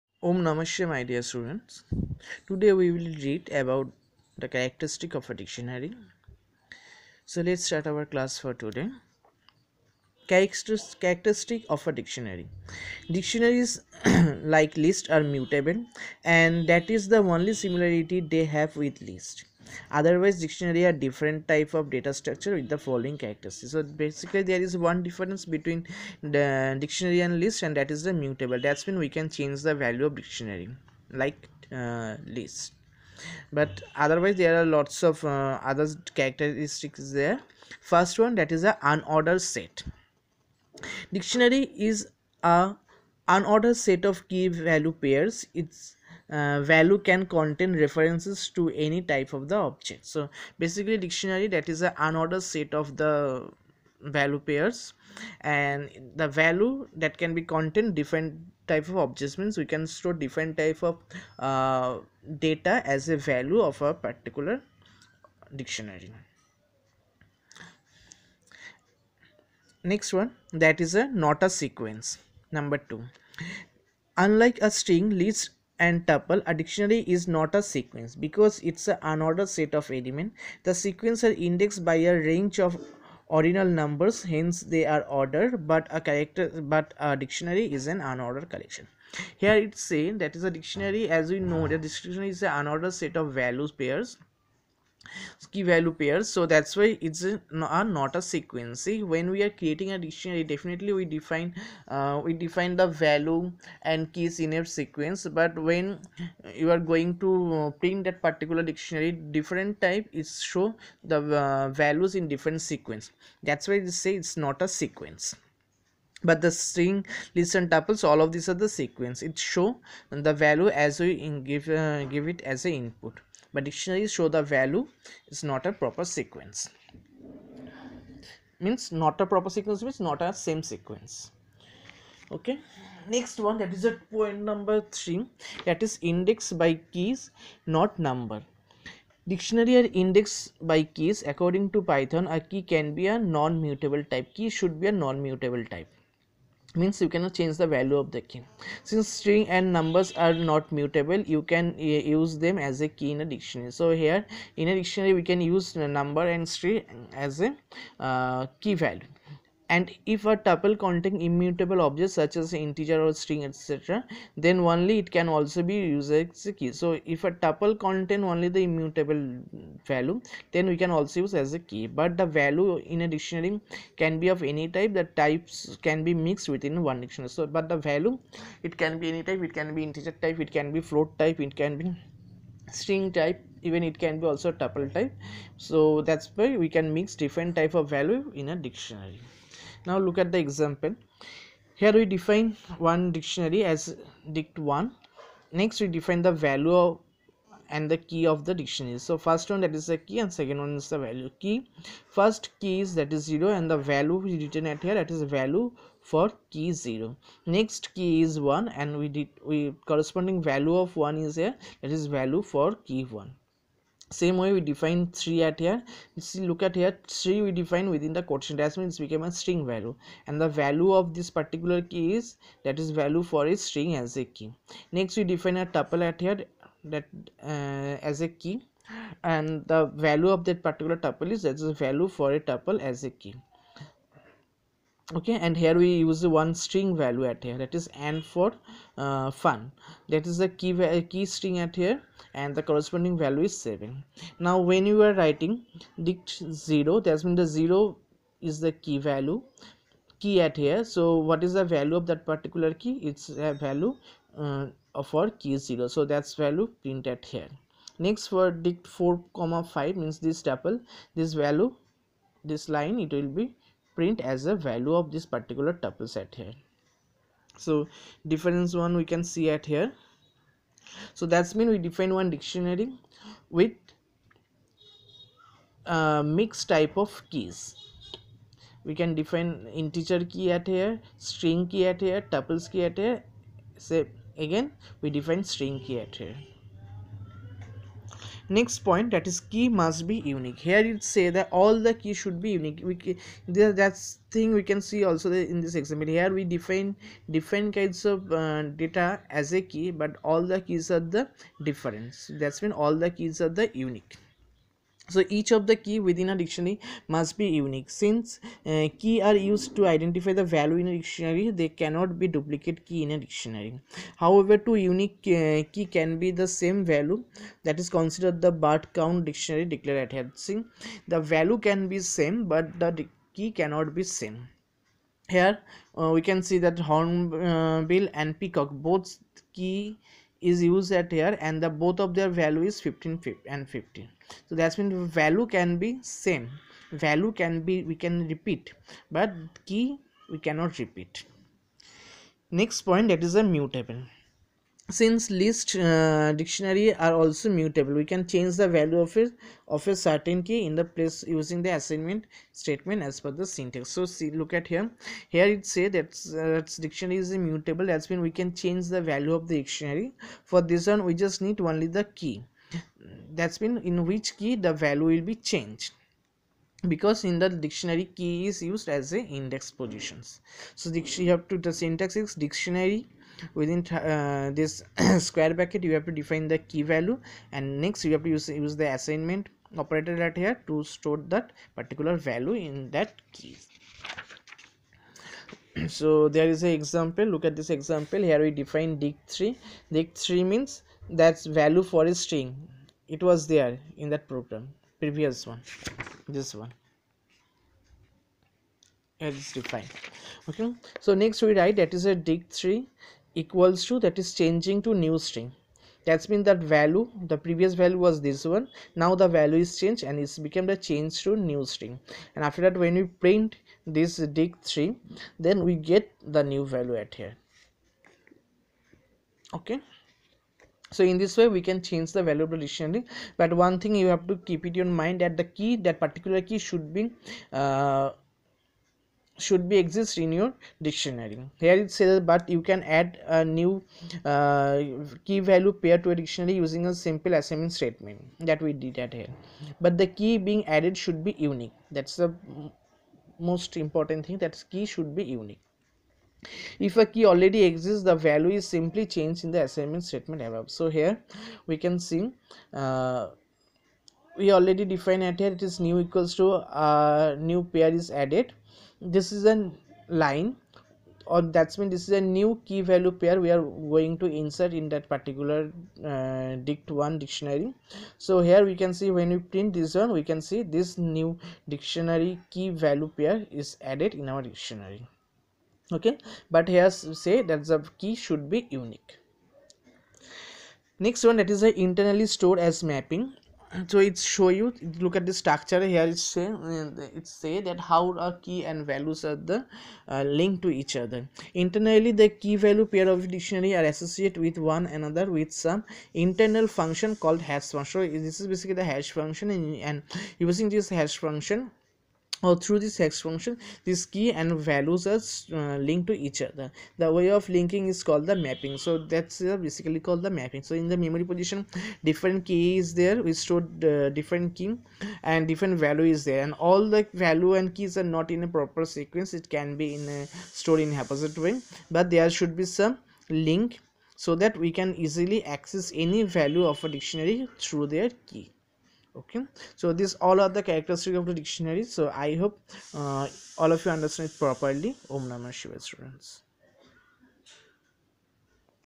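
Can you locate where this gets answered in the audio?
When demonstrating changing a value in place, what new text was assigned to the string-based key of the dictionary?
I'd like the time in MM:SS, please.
06:44.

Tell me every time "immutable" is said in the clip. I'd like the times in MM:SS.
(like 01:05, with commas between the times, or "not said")
02:41, 02:48, 05:57.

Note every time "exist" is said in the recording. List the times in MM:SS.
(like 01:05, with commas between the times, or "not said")
07:09, 07:27.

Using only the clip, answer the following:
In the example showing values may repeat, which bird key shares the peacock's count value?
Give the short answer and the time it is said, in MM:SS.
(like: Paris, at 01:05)
Hornbill, at 05:26.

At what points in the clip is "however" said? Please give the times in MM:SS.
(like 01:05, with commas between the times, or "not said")
05:14.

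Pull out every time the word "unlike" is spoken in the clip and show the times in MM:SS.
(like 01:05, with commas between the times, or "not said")
01:14.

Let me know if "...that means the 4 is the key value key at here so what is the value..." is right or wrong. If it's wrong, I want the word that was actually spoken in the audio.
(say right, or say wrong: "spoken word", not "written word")
wrong: "0", not "4".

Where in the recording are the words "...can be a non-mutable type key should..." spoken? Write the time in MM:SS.
02:22.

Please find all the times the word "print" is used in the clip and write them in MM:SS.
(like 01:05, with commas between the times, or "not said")
01:47, 04:16, 04:23, 06:53, 07:49.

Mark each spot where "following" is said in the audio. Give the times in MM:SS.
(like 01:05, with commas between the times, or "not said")
00:22.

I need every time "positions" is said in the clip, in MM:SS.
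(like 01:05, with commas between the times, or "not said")
06:09, 08:31.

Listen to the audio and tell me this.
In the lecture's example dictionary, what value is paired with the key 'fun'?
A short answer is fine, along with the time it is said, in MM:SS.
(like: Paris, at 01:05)
7, at 04:03.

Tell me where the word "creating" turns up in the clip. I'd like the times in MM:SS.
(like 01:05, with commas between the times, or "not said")
01:39.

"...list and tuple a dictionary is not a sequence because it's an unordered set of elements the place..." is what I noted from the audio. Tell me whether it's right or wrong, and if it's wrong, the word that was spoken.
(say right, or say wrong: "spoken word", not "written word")
wrong: "sequence", not "place".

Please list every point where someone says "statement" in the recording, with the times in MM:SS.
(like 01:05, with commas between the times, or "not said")
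05:52, 07:17, 07:30.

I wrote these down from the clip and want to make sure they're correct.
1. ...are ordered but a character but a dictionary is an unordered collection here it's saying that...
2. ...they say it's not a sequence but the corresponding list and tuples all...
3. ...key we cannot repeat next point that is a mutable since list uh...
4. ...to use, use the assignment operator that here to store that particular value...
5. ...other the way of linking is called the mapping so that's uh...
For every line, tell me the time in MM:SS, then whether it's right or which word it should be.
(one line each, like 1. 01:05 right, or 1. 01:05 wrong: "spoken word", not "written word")
1. 01:24 right
2. 01:53 wrong: "string", not "corresponding"
3. 05:39 right
4. 06:18 right
5. 08:26 right.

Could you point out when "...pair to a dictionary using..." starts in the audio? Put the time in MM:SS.
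07:15.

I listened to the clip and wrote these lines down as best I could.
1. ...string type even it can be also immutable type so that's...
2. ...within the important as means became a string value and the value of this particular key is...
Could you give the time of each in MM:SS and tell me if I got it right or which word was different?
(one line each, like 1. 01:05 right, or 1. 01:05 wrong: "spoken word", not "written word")
1. 03:02 wrong: "tuple", not "immutable"
2. 03:37 wrong: "quotient", not "important".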